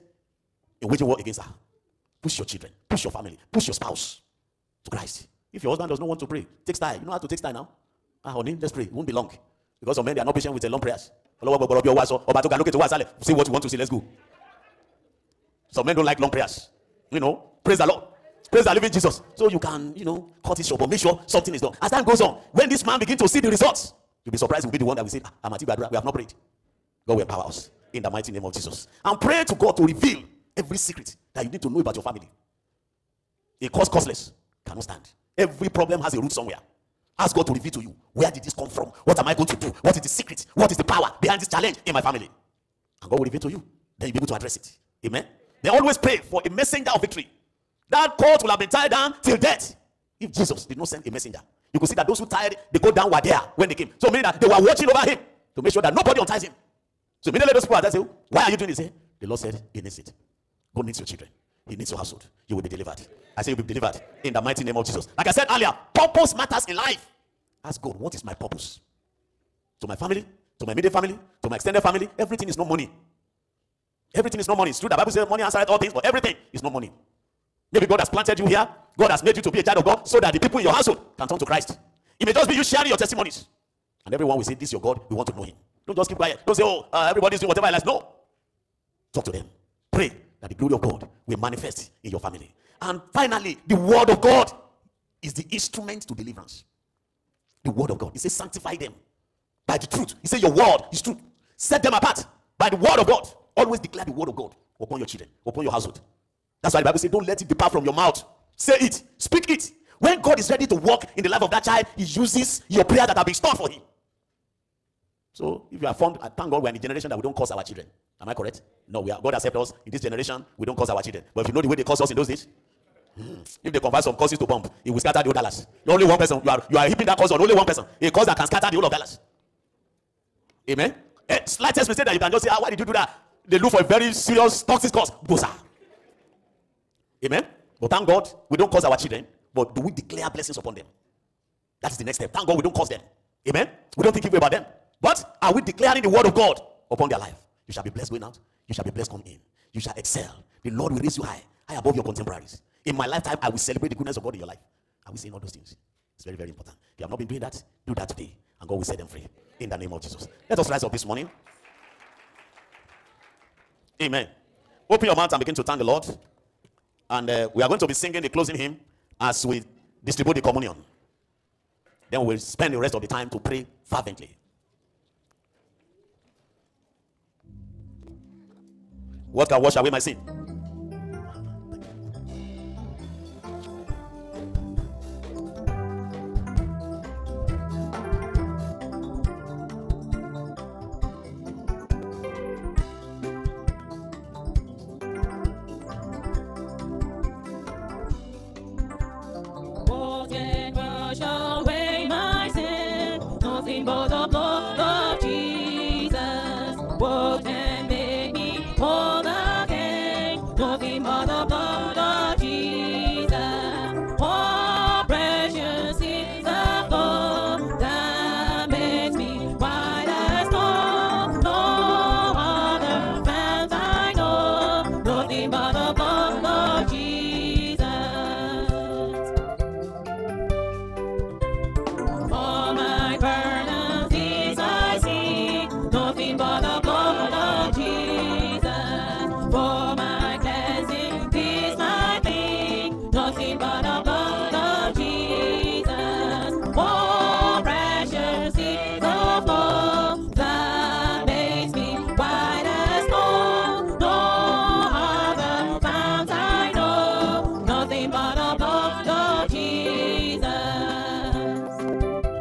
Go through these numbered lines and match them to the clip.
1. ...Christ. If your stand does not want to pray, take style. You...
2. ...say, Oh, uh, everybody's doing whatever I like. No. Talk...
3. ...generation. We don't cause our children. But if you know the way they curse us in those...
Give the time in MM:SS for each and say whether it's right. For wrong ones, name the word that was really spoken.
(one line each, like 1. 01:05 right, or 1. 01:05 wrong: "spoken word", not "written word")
1. 00:04 wrong: "husband", not "stand"
2. 01:26 right
3. 02:00 wrong: "curse", not "cause".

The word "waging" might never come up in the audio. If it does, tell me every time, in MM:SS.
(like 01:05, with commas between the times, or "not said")
00:00.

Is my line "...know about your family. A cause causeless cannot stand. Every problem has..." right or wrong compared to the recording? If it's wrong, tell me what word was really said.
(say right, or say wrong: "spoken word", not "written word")
right.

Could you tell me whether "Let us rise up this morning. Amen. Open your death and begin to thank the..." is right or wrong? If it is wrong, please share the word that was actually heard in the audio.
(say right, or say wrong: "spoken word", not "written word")
wrong: "mouth", not "death".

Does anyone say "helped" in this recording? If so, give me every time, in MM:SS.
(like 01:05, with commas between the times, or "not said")
01:59.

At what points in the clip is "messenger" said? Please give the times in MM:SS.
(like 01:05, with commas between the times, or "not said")
00:46, 00:51.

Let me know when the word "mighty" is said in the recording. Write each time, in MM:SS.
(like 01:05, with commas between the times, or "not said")
00:28, 01:04.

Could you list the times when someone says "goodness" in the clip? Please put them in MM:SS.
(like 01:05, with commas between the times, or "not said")
02:33.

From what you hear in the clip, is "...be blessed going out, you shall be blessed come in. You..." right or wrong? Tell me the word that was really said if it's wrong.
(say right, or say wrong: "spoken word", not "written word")
right.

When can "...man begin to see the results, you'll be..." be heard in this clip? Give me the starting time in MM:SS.
00:22.